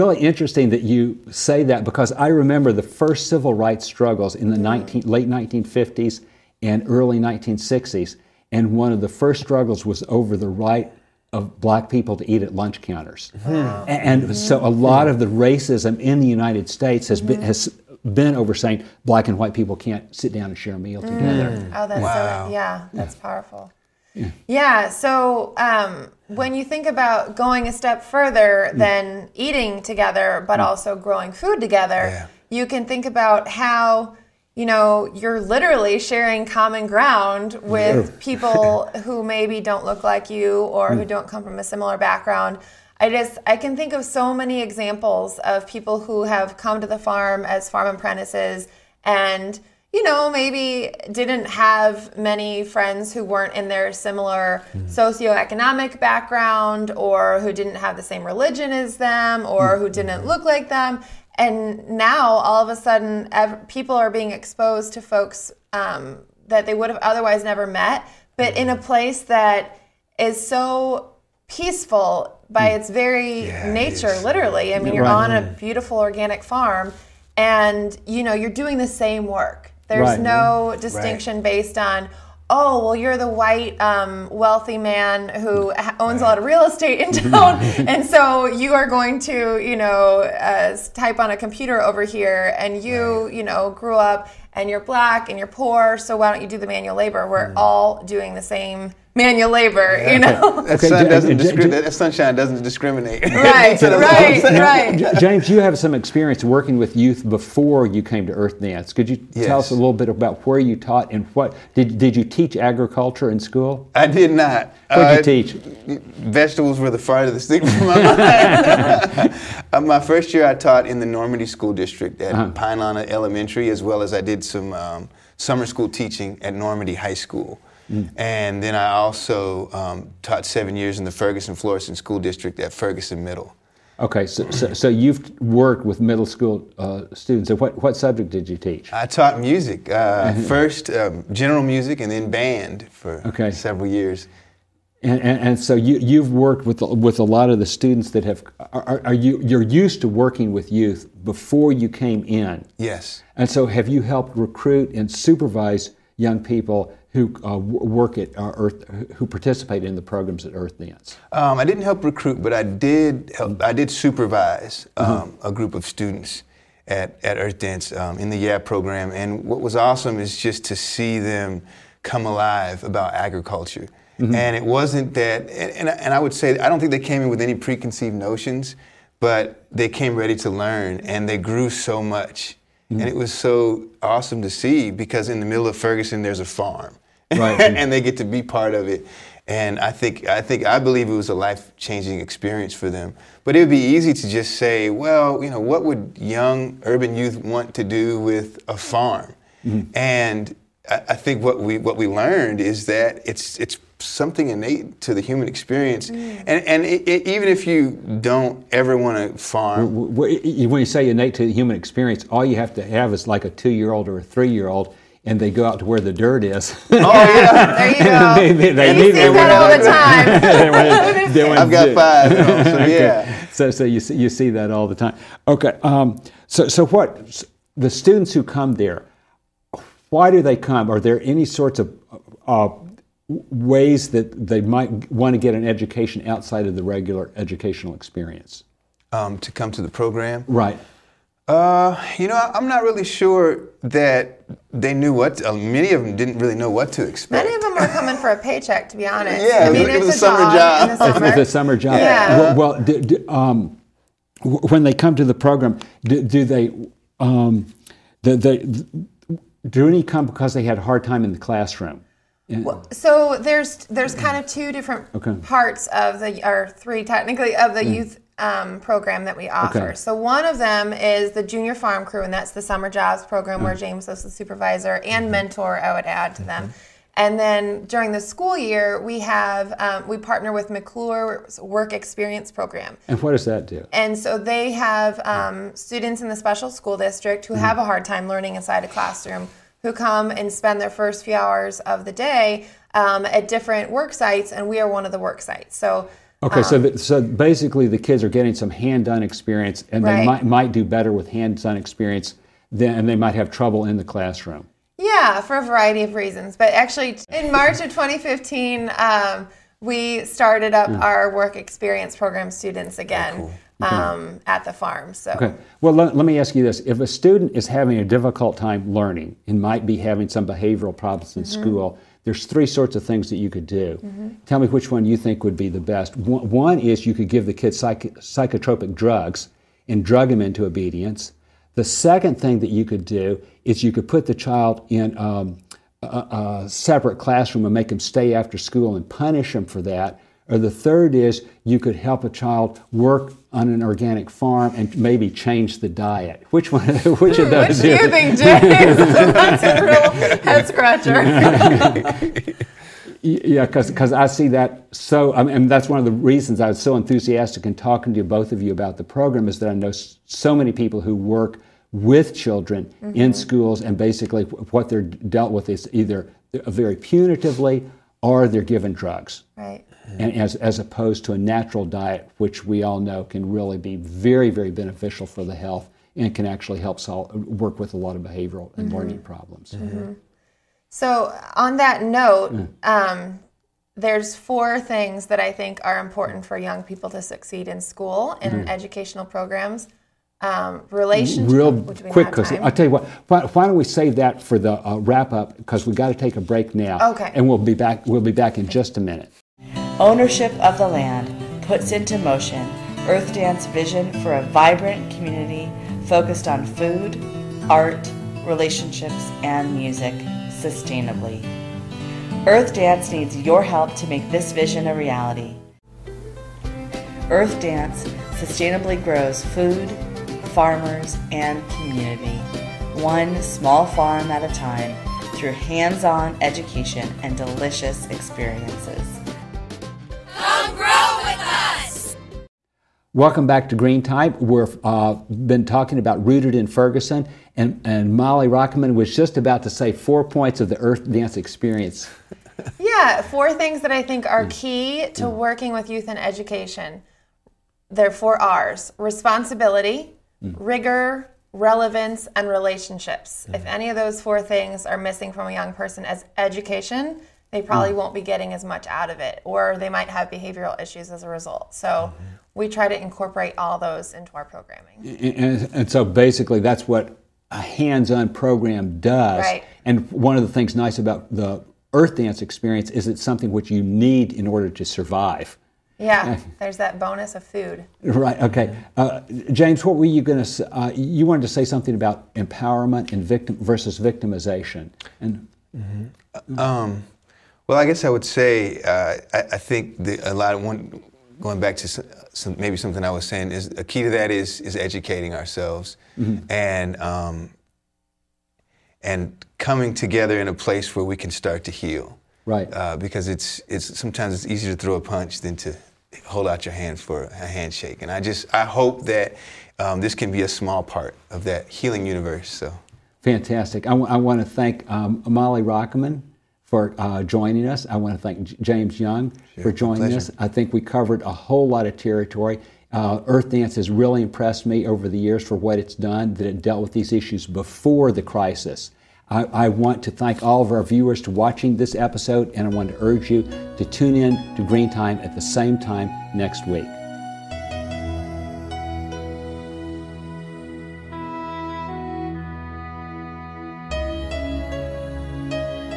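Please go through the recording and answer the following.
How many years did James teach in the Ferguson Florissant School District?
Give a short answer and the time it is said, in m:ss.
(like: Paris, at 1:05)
7, at 2:10.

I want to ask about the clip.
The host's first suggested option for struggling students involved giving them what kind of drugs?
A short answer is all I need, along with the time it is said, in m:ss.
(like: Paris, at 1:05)
psychotropic drugs, at 5:28.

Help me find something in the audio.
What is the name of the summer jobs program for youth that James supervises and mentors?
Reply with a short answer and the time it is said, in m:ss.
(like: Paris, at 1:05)
junior farm crew, at 4:31.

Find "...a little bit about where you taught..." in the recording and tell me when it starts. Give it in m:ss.
1:49.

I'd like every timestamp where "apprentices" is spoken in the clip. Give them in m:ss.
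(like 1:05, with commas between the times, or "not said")
0:47.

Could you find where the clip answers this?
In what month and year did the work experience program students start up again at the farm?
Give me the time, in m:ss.
5:07.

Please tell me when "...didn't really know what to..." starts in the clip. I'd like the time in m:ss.
4:06.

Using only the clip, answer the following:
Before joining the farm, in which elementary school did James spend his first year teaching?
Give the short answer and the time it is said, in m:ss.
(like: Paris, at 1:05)
Pine Lawn Elementary, at 2:02.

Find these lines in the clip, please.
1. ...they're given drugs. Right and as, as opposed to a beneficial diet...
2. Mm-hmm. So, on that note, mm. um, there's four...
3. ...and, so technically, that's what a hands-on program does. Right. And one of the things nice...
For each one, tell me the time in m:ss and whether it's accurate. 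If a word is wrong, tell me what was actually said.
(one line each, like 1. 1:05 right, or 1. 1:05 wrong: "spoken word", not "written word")
1. 6:08 wrong: "natural", not "beneficial"
2. 6:19 right
3. 7:45 wrong: "basically", not "technically".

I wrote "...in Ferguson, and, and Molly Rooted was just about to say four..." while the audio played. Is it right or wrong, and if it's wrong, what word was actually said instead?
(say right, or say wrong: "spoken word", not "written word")
wrong: "Rockamann", not "Rooted".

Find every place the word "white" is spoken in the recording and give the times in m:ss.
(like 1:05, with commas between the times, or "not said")
0:19, 1:23.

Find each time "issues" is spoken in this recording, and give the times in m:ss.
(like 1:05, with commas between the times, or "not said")
7:40, 8:47.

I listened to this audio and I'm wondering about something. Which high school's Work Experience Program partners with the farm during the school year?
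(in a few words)
McCluer.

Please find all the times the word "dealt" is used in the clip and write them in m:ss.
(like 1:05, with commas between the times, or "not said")
6:05, 8:46.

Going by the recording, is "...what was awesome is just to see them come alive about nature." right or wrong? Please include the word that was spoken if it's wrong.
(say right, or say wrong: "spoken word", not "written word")
wrong: "agriculture", not "nature".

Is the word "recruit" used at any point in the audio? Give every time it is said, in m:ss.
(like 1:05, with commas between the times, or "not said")
2:34, 2:42.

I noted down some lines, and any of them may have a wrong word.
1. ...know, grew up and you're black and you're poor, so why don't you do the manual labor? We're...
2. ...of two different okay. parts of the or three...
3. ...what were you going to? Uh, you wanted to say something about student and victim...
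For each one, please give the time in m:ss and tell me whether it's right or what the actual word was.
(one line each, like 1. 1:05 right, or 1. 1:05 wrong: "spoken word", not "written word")
1. 1:33 right
2. 4:24 right
3. 7:59 wrong: "empowerment", not "student".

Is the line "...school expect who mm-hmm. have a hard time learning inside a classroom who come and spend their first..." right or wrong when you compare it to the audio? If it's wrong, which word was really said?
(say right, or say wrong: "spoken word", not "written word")
wrong: "district", not "expect".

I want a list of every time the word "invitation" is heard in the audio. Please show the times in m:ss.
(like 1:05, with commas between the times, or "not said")
not said.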